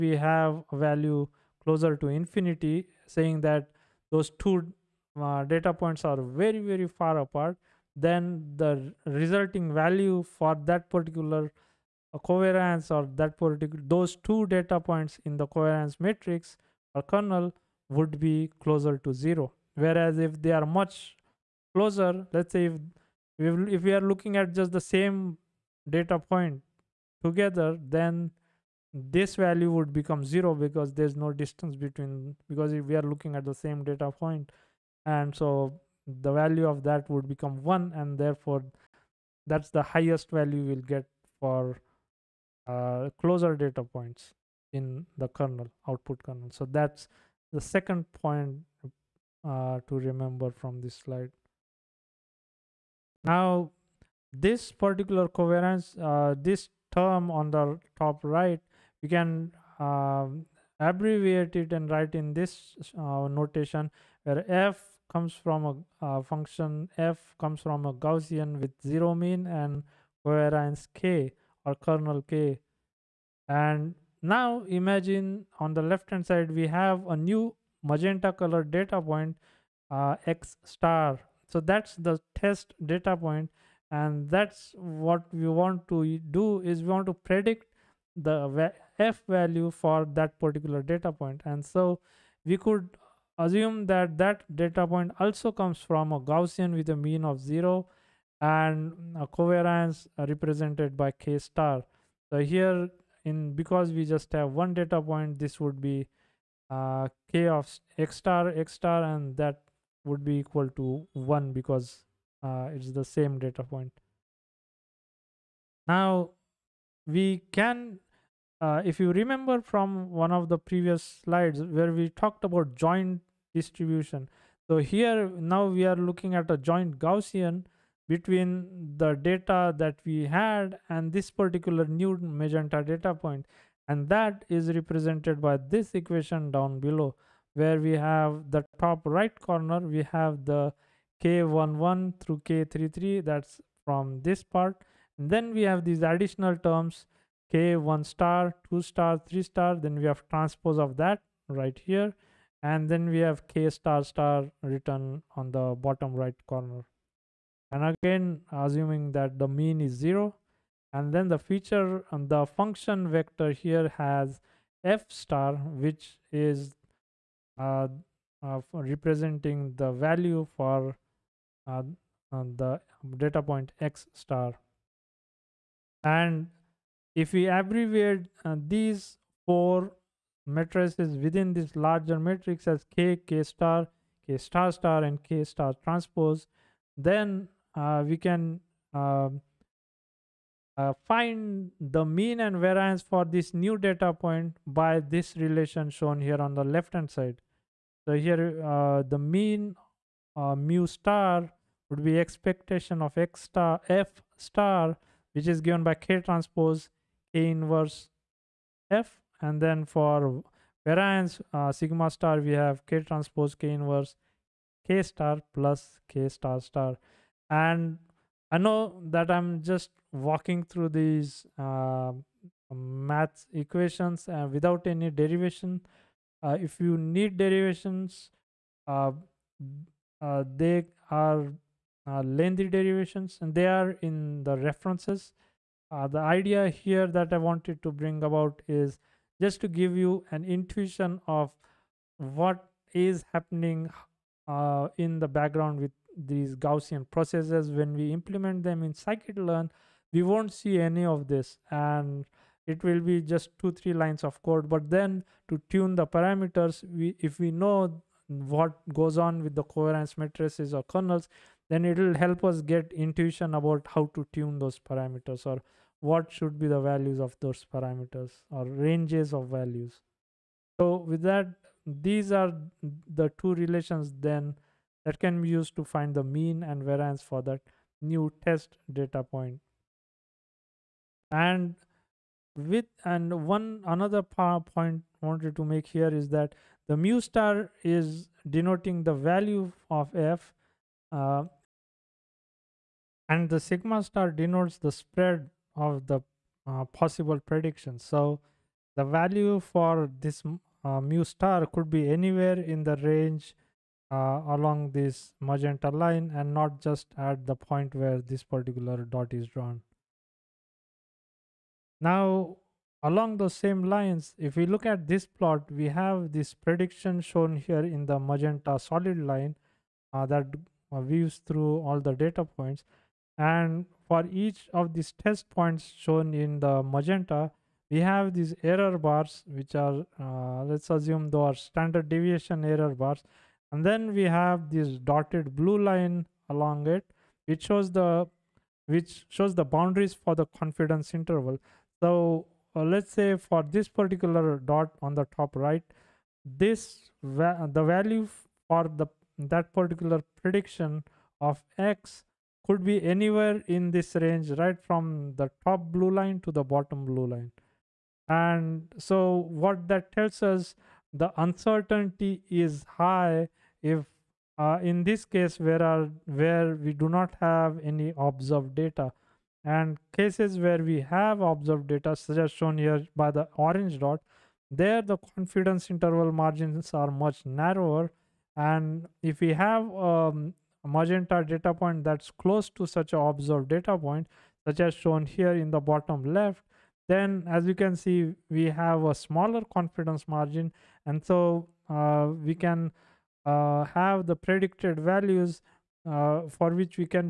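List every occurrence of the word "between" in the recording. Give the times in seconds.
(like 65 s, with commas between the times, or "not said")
31 s, 128 s.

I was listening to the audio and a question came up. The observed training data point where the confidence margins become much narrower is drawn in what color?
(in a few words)
Orange.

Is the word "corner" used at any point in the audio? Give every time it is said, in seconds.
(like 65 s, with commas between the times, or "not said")
139 s, 156 s.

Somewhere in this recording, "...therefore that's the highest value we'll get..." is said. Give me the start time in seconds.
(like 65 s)
38 s.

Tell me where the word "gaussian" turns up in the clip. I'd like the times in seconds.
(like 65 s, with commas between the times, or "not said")
67 s, 96 s, 126 s, 246 s.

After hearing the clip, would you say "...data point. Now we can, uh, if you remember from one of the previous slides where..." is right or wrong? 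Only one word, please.
right.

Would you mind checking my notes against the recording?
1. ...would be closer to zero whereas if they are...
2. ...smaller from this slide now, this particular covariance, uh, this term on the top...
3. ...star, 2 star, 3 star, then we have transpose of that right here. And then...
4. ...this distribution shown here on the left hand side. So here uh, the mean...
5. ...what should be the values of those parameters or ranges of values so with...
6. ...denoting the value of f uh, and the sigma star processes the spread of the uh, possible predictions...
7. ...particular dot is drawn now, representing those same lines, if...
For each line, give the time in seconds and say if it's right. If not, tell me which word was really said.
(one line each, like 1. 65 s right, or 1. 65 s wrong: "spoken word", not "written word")
1. 17 s right
2. 50 s wrong: "remember", not "smaller"
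3. 148 s right
4. 194 s wrong: "relation", not "distribution"
5. 266 s right
6. 288 s wrong: "denotes", not "processes"
7. 308 s wrong: "along", not "representing".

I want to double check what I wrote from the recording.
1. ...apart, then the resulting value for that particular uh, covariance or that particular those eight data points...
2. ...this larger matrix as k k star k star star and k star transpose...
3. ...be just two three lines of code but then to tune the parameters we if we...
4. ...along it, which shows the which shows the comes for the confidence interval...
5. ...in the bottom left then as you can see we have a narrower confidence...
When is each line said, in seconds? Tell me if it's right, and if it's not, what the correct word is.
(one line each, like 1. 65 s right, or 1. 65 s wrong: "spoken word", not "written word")
1. 7 s wrong: "two", not "eight"
2. 181 s right
3. 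252 s right
4. 336 s wrong: "boundaries", not "comes"
5. 385 s wrong: "smaller", not "narrower".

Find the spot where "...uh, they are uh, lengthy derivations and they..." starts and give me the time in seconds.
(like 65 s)
230 s.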